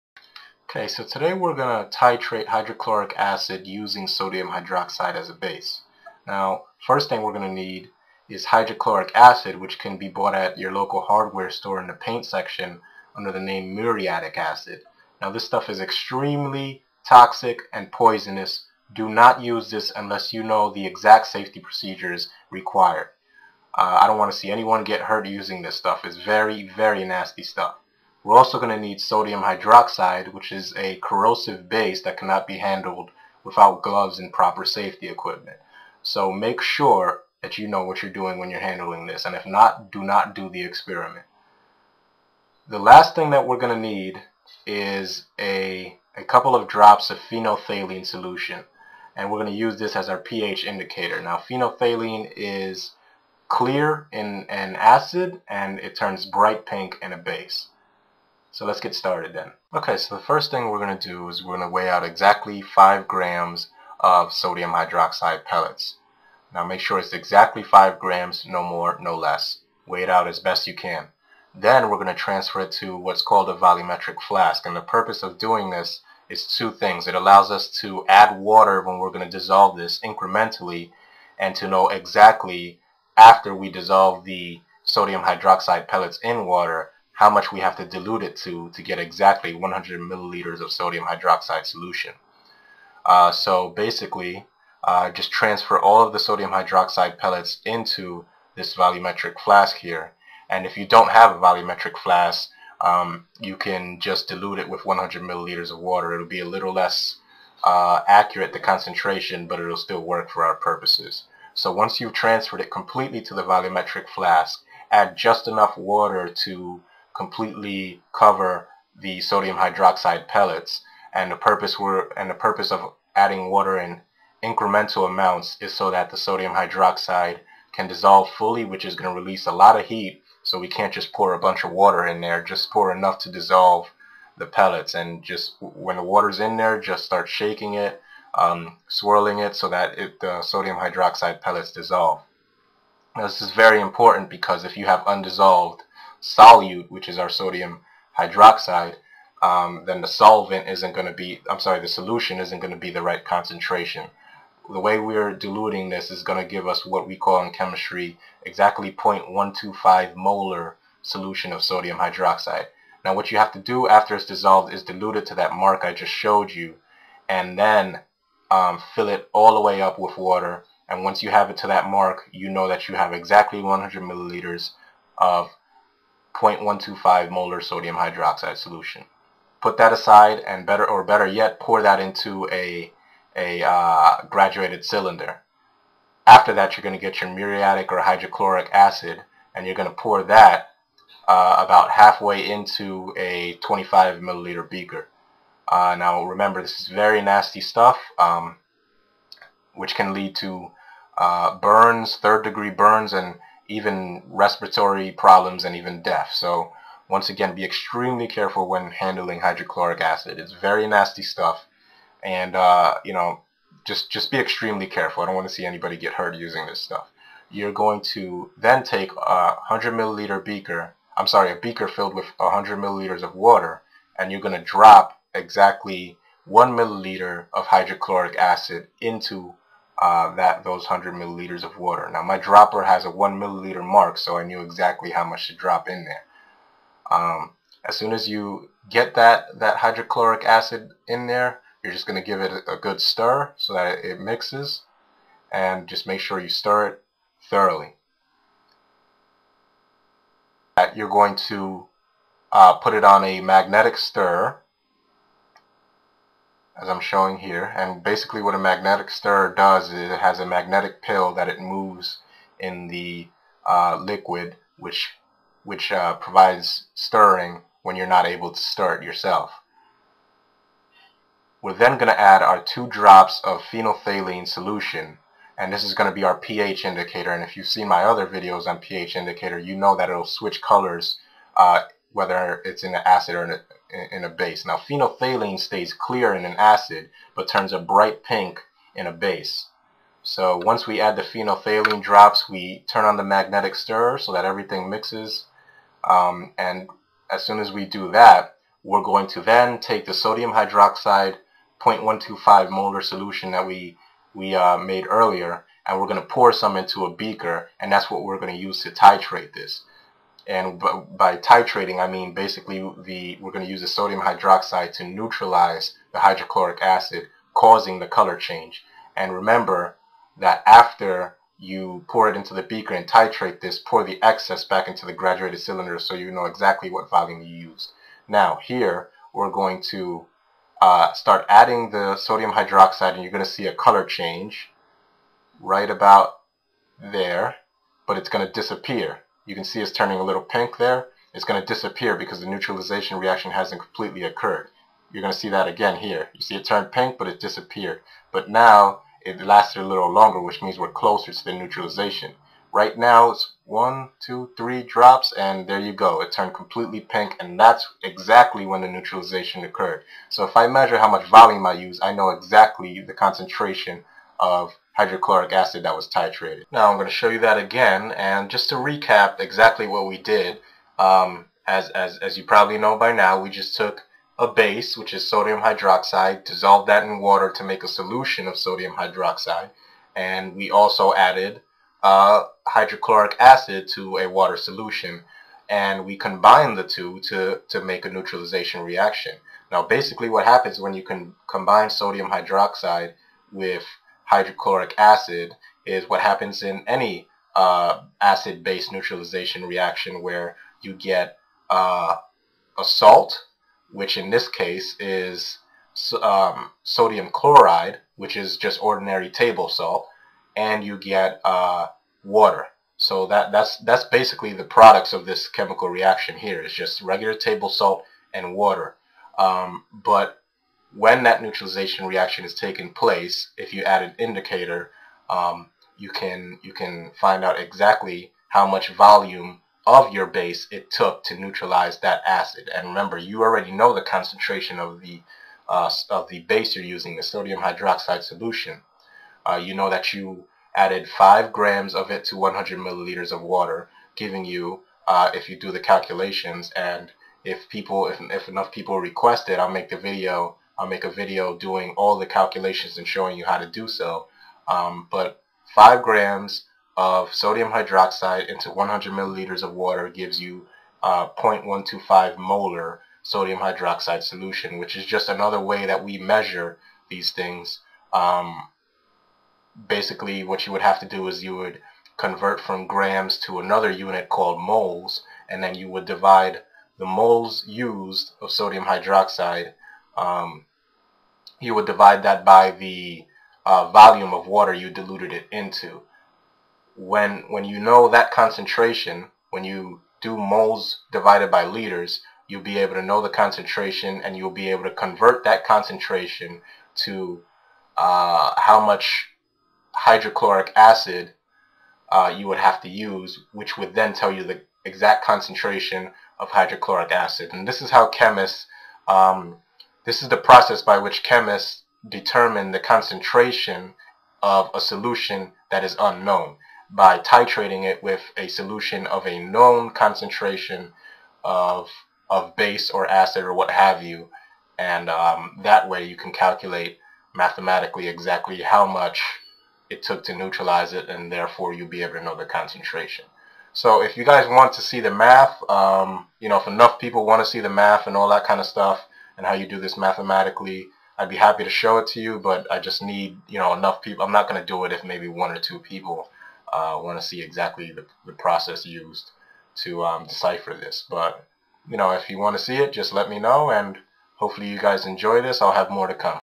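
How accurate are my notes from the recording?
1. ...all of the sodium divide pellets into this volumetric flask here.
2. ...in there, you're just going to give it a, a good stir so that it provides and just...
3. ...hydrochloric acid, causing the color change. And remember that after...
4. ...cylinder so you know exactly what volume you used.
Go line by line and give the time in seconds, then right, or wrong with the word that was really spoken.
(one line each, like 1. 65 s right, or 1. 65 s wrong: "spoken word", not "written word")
1. 95 s wrong: "hydroxide", not "divide"
2. 241 s wrong: "mixes", not "provides"
3. 316 s right
4. 325 s right.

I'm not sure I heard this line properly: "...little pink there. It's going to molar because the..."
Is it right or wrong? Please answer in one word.
wrong.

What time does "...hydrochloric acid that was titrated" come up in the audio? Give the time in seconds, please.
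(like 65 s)
364 s.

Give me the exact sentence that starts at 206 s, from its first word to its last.
So once again, be extremely careful when handling hydrochloric acid.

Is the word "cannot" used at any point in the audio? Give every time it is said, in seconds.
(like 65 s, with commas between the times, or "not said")
32 s.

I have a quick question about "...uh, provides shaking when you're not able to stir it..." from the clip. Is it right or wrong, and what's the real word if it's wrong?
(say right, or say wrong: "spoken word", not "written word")
wrong: "stirring", not "shaking".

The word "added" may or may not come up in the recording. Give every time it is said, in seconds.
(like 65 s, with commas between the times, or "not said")
381 s, 440 s.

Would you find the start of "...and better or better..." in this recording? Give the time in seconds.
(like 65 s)
180 s.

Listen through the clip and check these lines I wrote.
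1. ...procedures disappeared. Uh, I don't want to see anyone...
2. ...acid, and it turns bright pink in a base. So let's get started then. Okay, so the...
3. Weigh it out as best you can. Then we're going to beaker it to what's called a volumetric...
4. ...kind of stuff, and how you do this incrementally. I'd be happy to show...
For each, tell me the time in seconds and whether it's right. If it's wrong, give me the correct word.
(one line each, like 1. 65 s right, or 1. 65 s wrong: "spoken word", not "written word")
1. 21 s wrong: "required", not "disappeared"
2. 54 s right
3. 69 s wrong: "transfer", not "beaker"
4. 538 s wrong: "mathematically", not "incrementally".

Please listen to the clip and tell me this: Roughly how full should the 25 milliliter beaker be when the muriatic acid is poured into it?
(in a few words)
about halfway.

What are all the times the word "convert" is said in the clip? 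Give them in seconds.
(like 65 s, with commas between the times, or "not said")
472 s, 494 s.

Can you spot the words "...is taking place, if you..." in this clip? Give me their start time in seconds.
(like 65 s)
422 s.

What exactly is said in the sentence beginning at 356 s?
It turned completely pink, and that's exactly when the neutralization occurred.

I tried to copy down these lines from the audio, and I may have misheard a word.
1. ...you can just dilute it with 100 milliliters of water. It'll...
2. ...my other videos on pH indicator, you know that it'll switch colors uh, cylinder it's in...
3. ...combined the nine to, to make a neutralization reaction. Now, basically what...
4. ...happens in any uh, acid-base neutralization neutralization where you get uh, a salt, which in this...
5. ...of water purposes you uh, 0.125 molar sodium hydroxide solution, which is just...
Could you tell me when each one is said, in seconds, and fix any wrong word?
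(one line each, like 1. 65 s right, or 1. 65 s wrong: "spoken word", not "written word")
1. 103 s right
2. 277 s wrong: "whether", not "cylinder"
3. 386 s wrong: "two", not "nine"
4. 396 s wrong: "reaction", not "neutralization"
5. 459 s wrong: "gives", not "purposes".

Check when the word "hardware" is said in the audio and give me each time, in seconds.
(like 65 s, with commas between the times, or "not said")
11 s.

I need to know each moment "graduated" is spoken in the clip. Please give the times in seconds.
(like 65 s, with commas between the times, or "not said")
184 s, 325 s.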